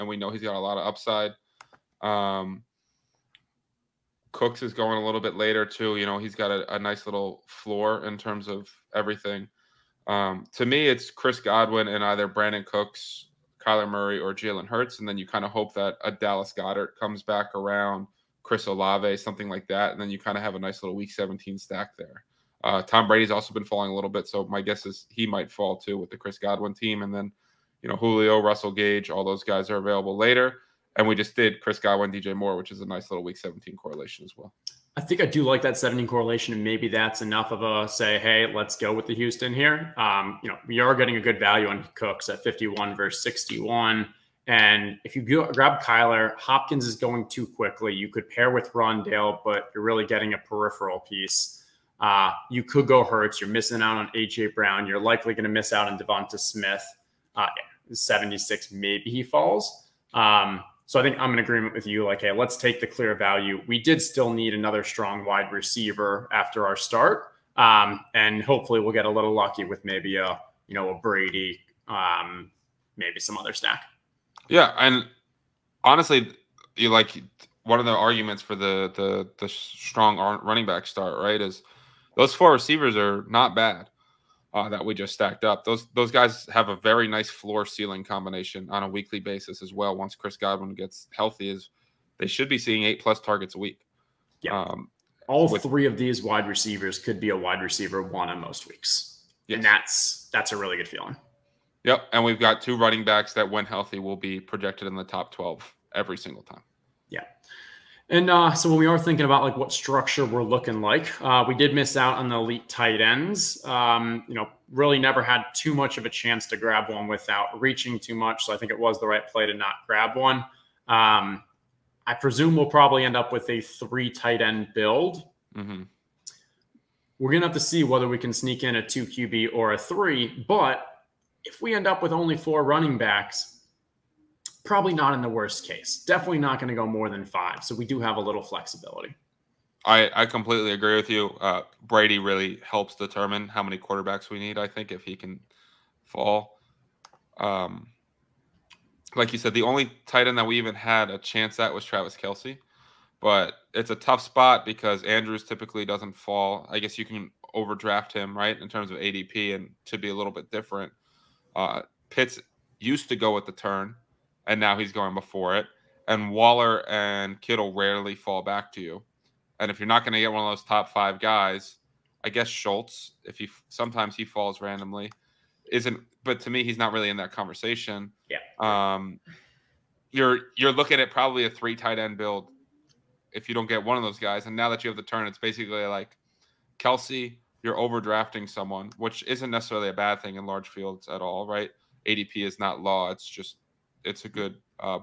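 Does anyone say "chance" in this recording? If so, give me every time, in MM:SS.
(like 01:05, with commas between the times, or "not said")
01:56, 02:31.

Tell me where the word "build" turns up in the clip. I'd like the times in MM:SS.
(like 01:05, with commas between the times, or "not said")
02:04, 03:02.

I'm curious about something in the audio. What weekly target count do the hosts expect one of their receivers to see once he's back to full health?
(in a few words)
8 plus.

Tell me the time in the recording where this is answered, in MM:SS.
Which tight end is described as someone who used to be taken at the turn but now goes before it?
02:42.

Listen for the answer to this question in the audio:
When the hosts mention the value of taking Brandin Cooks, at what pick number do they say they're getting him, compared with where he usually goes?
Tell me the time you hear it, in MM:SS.
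00:42.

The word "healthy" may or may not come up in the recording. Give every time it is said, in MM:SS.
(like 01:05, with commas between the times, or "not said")
01:31, 01:43.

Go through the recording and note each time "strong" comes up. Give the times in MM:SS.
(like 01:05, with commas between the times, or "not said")
01:04, 01:19.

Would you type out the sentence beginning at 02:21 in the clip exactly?
Uh, Brady really helps determine how many quarterbacks we need.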